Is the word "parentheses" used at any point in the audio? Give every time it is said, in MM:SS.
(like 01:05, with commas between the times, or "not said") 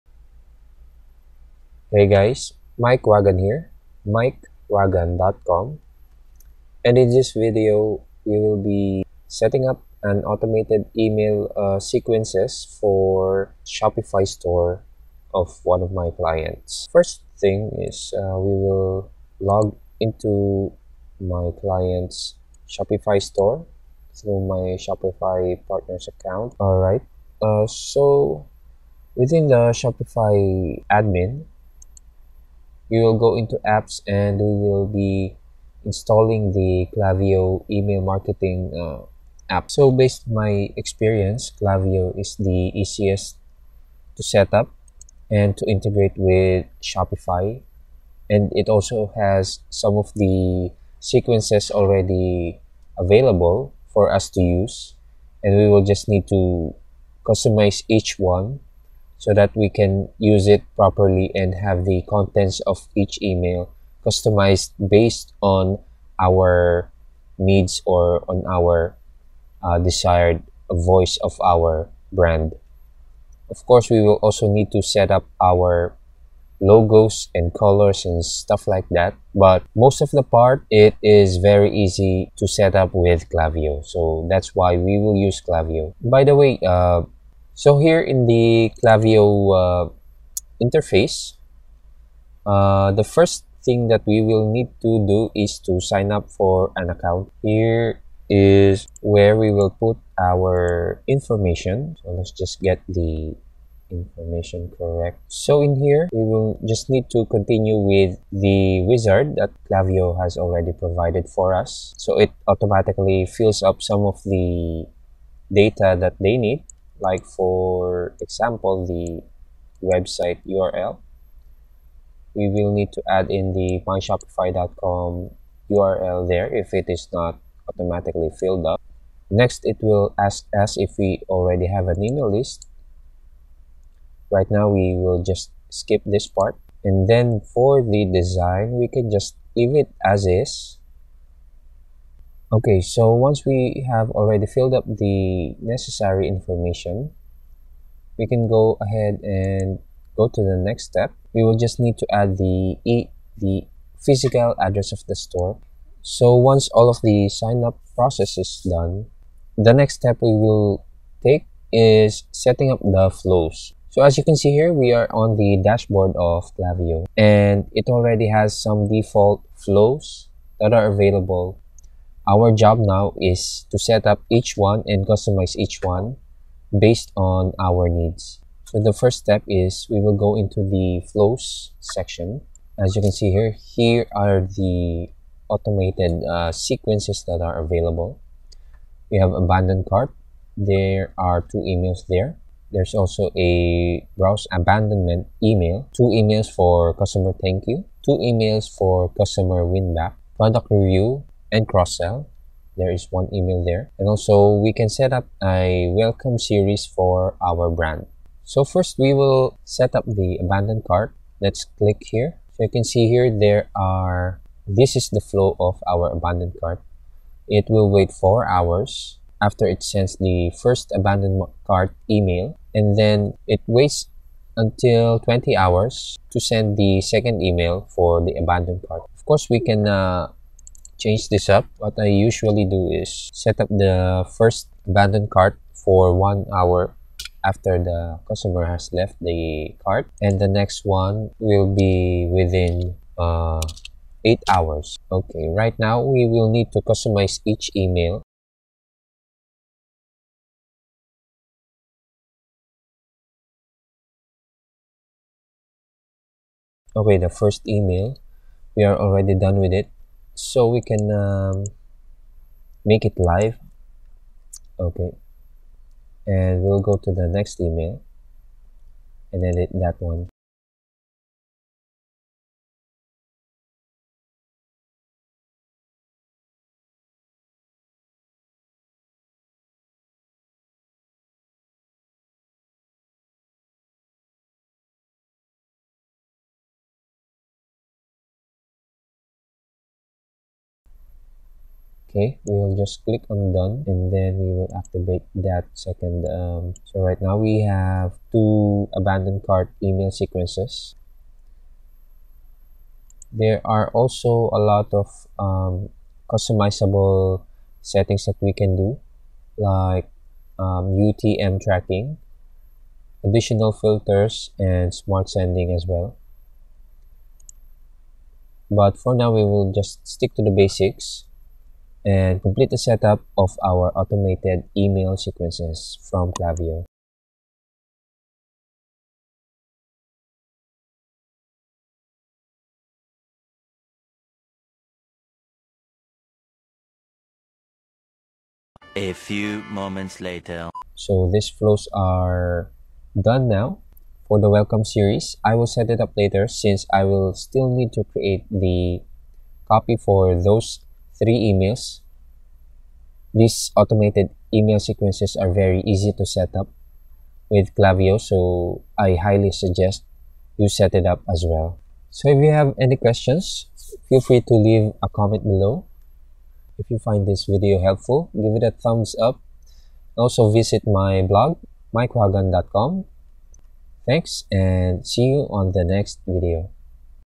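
not said.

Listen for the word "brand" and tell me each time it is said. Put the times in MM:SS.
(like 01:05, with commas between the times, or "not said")
01:12, 03:27.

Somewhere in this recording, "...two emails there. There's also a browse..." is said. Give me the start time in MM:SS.
03:11.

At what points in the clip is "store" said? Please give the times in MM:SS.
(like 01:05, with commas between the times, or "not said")
00:14, 00:23, 02:35.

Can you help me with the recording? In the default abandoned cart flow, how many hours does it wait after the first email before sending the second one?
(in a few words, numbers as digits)
20.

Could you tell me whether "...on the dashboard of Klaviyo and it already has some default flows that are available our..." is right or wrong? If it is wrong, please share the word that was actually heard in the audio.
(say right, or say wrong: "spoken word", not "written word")
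right.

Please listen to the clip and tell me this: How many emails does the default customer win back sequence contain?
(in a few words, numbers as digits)
2.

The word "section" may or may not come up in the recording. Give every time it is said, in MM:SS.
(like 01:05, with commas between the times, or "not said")
03:01.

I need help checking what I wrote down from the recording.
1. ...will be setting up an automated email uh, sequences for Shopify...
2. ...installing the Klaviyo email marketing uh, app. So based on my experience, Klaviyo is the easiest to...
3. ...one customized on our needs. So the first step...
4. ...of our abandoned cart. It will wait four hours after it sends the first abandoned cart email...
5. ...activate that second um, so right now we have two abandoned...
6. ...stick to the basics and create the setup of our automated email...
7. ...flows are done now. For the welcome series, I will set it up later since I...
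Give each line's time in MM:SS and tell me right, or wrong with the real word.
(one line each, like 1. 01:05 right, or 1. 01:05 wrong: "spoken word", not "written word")
1. 00:08 right
2. 00:35 right
3. 02:55 wrong: "based", not "customized"
4. 03:35 right
5. 04:54 right
6. 05:20 wrong: "complete", not "create"
7. 05:41 right.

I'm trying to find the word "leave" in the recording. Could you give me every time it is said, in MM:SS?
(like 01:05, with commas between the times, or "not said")
02:19, 06:04.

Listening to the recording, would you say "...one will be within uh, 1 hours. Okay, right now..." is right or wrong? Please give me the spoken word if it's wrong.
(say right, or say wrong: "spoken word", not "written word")
wrong: "8", not "1".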